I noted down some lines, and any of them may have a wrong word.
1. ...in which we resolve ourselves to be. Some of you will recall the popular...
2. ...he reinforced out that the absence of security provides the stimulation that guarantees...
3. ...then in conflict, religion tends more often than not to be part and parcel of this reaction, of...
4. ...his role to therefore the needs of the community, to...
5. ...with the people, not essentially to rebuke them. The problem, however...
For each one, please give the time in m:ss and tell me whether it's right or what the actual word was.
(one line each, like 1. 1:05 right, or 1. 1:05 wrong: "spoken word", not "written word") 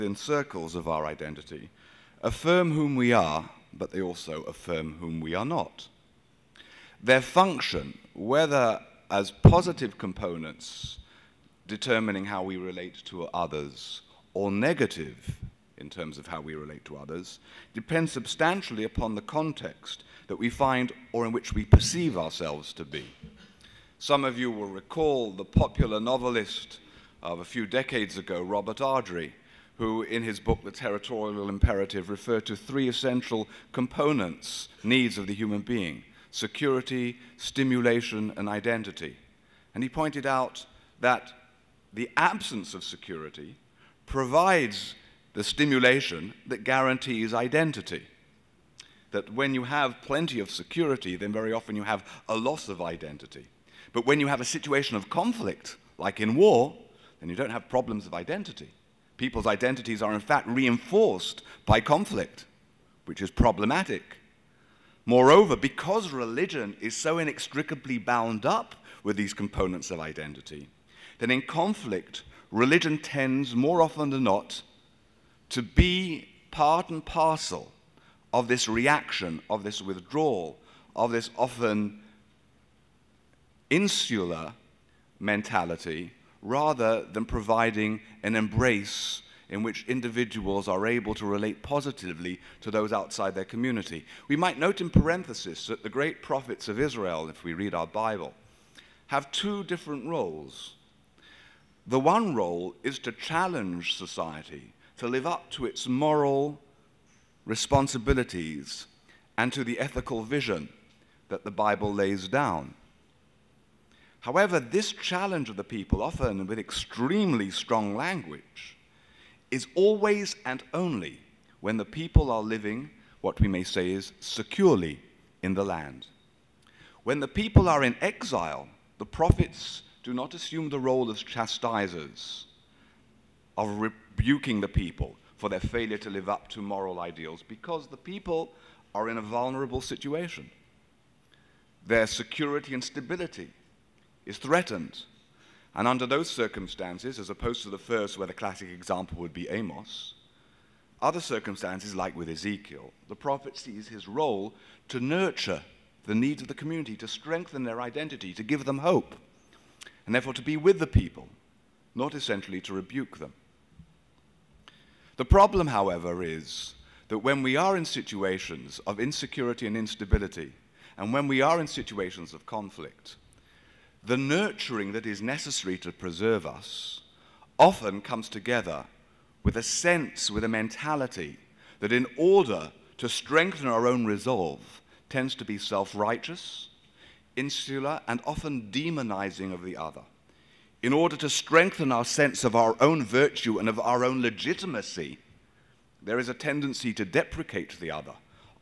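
1. 0:21 wrong: "perceive", not "resolve"
2. 0:39 wrong: "pointed", not "reinforced"
3. 1:11 right
4. 2:33 wrong: "nurture", not "therefore"
5. 2:40 right.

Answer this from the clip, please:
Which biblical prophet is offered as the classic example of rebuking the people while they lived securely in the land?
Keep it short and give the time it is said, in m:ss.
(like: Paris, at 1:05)
Amos, at 2:29.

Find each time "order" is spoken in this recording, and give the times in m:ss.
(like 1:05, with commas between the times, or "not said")
3:02, 3:10.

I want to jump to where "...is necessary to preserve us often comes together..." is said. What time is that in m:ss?
2:55.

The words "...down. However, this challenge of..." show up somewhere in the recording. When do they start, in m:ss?
1:52.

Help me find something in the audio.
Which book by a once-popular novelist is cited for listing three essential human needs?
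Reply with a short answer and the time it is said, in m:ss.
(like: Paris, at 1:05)
The Territorial Imperative, at 0:30.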